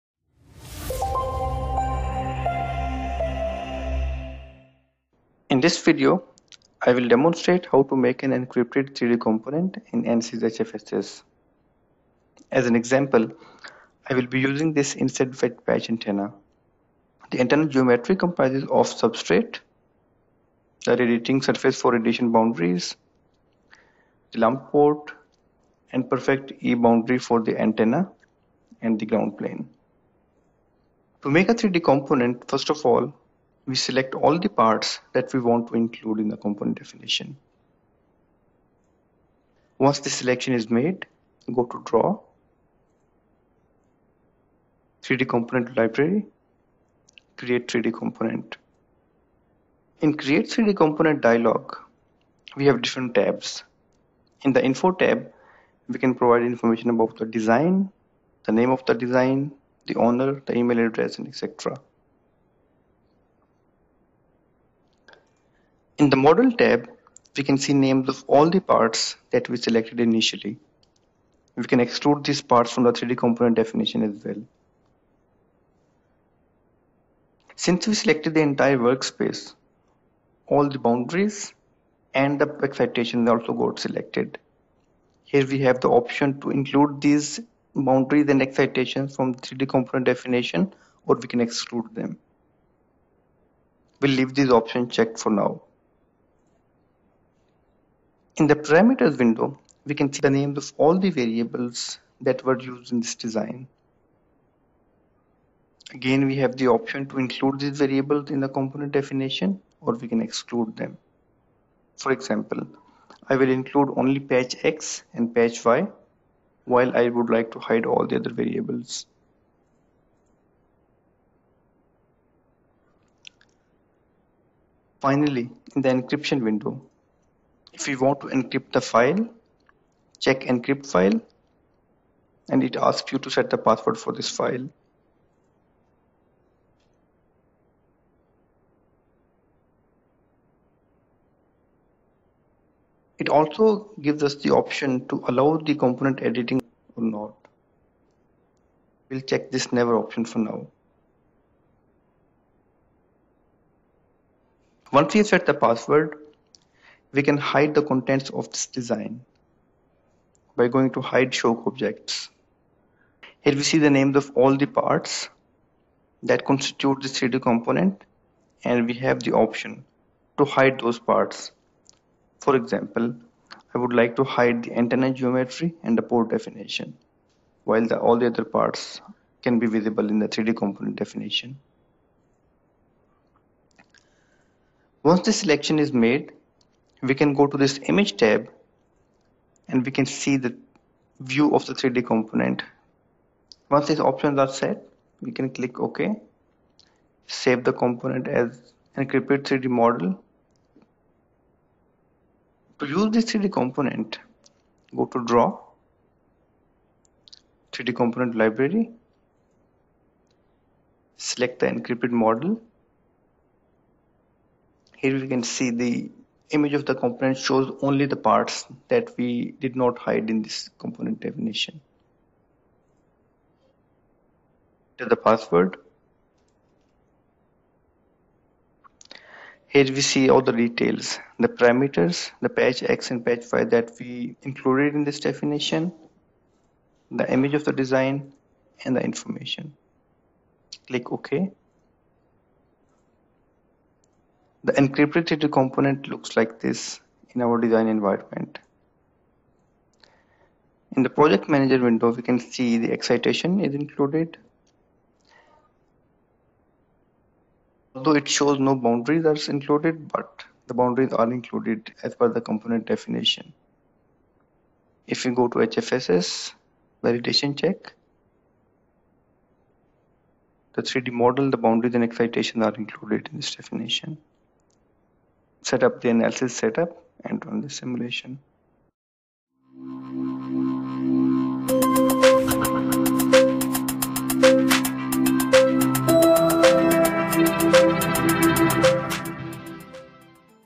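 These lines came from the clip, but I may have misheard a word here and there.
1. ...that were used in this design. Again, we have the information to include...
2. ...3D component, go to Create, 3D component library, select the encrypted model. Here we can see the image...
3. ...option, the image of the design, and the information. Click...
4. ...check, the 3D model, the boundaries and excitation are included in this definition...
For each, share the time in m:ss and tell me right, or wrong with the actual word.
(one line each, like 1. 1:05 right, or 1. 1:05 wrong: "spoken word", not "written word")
1. 1:42 wrong: "option", not "information"
2. 3:23 wrong: "Draw", not "Create"
3. 3:55 wrong: "definition", not "option"
4. 4:27 right.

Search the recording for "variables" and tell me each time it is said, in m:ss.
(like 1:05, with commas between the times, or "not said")
1:41, 1:47, 1:58.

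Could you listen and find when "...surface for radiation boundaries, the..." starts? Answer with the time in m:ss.
0:21.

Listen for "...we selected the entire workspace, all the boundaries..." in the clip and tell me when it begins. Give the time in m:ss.
1:17.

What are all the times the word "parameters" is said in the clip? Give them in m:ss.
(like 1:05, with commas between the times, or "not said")
1:38, 3:51.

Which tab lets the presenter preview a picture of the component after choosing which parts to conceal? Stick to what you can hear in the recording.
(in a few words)
Image tab.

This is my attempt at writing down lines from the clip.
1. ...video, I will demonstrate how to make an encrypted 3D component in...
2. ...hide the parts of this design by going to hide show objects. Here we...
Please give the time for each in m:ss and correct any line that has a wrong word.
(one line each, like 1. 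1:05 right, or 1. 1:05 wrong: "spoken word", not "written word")
1. 0:05 right
2. 2:37 wrong: "contents", not "parts".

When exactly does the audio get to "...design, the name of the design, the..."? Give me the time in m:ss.
0:57.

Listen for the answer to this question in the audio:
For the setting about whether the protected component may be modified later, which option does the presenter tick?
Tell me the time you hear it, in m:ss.
2:29.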